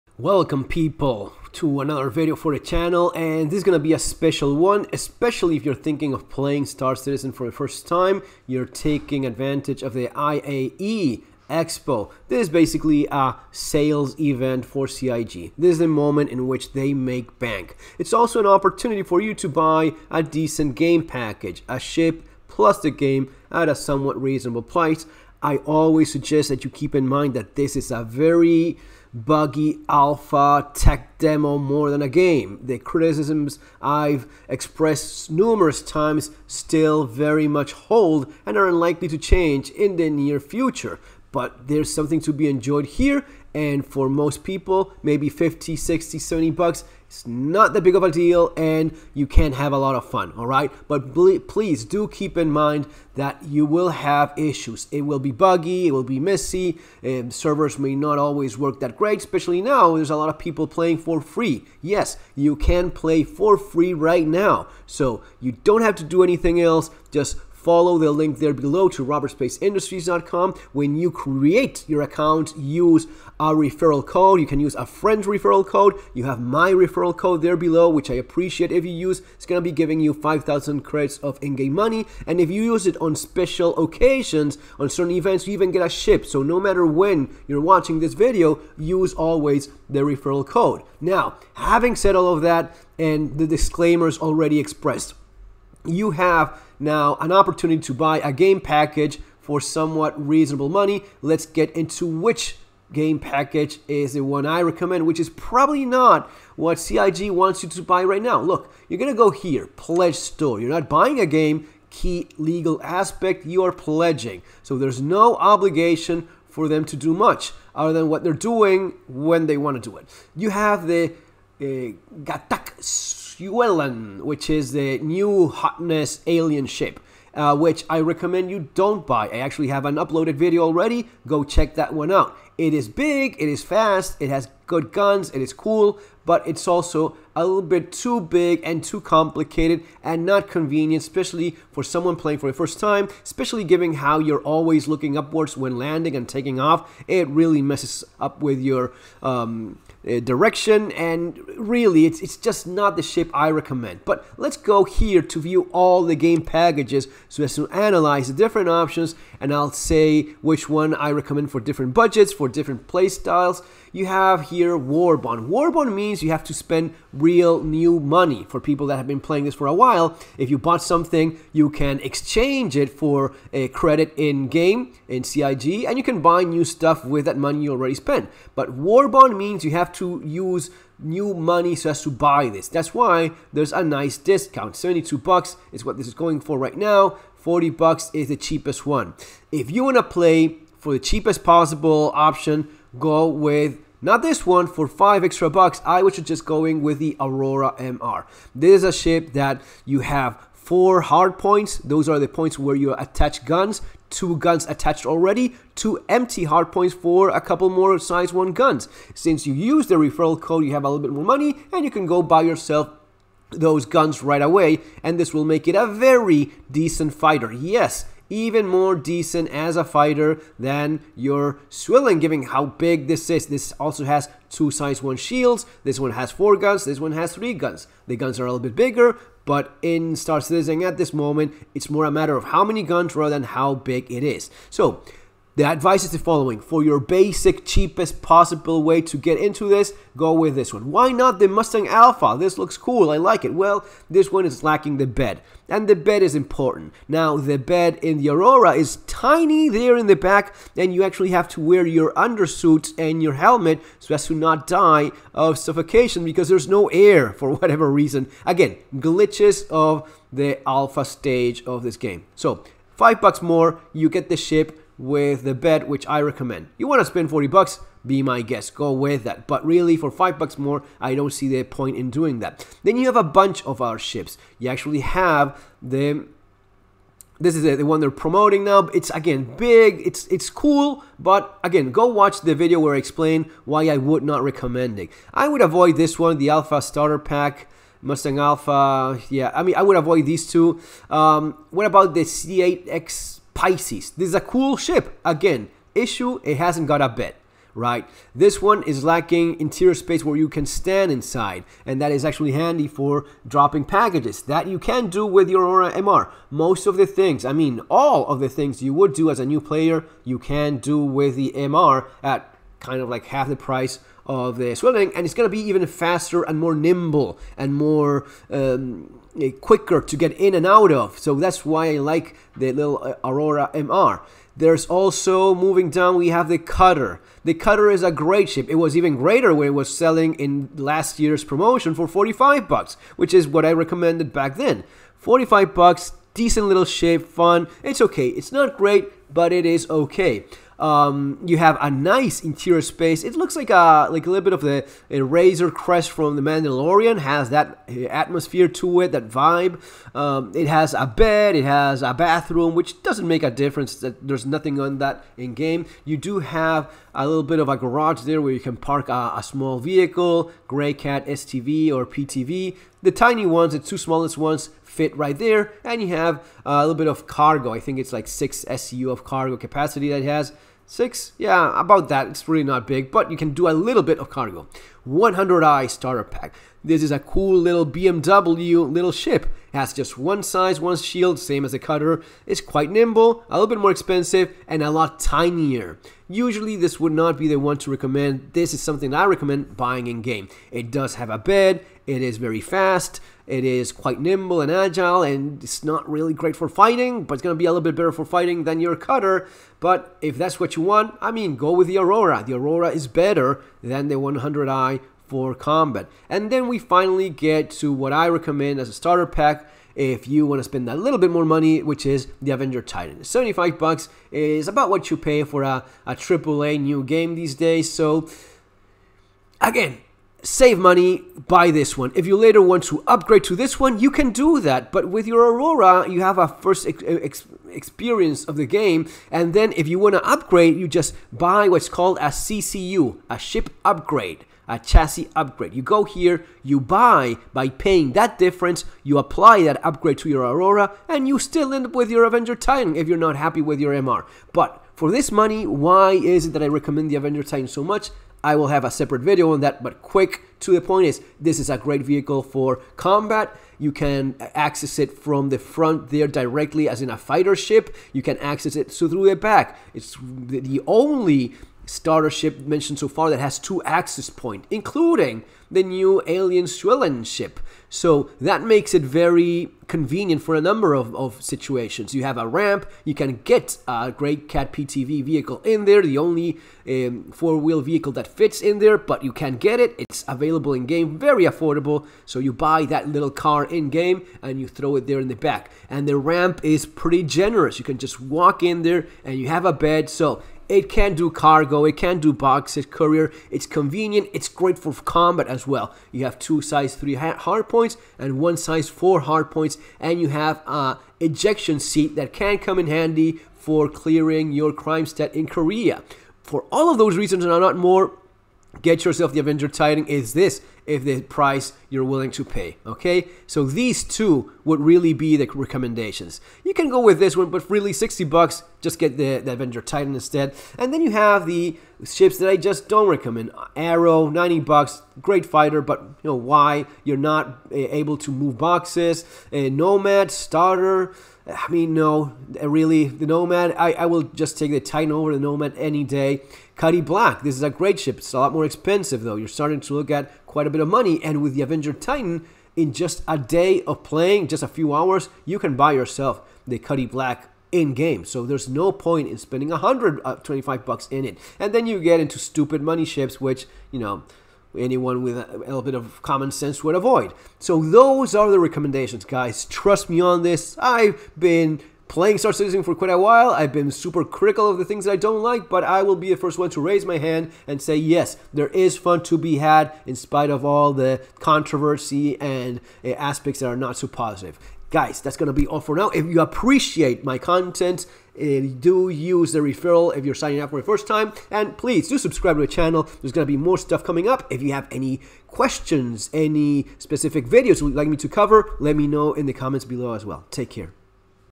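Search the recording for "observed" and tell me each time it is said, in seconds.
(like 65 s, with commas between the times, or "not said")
not said.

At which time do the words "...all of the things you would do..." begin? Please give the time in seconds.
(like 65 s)
307 s.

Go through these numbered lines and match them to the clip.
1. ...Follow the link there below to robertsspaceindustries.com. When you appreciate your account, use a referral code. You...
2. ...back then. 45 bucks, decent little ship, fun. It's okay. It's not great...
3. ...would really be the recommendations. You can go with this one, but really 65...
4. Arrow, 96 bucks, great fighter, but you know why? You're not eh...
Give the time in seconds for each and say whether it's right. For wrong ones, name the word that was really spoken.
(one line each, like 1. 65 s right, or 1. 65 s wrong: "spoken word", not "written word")
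1. 67 s wrong: "create", not "appreciate"
2. 334 s right
3. 514 s wrong: "60", not "65"
4. 523 s wrong: "90", not "96".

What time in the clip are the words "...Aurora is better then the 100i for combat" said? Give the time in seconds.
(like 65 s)
402 s.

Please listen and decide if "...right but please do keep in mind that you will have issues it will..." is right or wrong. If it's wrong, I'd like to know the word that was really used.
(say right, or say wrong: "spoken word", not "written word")
right.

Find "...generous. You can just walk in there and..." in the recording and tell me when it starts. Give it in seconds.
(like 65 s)
487 s.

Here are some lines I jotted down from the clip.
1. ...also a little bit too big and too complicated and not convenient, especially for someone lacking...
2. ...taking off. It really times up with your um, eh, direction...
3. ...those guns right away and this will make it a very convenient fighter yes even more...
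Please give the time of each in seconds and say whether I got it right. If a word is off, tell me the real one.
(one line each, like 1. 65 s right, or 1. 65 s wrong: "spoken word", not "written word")
1. 136 s wrong: "playing", not "lacking"
2. 146 s wrong: "messes", not "times"
3. 213 s wrong: "decent", not "convenient".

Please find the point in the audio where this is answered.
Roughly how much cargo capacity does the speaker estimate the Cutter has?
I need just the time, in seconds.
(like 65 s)
368 s.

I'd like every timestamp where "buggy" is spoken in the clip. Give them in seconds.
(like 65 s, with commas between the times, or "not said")
29 s, 55 s.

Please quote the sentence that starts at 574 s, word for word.
Guys, that's going to be all for now.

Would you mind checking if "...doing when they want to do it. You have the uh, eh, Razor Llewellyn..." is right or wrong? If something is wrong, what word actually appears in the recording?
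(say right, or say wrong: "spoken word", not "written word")
wrong: "Gatac", not "Razor".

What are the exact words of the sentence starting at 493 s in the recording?
It's convenient, it's great for combat as well.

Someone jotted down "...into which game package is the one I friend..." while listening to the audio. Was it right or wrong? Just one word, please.
wrong.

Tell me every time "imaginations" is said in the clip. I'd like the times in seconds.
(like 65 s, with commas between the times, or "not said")
not said.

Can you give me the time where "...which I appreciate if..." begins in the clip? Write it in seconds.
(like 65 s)
77 s.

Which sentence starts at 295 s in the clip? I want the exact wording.
Again, issue, it hasn't got a bed right?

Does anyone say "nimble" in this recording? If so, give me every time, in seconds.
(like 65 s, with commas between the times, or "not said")
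316 s, 382 s, 394 s.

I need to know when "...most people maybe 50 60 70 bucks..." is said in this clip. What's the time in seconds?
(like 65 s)
44 s.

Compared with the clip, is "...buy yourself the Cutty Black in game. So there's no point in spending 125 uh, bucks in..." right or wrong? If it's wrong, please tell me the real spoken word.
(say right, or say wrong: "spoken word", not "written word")
right.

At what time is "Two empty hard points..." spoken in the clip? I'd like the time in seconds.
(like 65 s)
205 s.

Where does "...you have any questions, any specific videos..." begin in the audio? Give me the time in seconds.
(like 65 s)
584 s.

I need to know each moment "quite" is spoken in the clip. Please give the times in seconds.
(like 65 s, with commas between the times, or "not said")
382 s, 393 s, 540 s, 562 s.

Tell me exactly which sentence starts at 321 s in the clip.
So that's why I like the little eh, Aurora MR.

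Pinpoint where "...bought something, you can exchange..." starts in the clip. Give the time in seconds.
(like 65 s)
170 s.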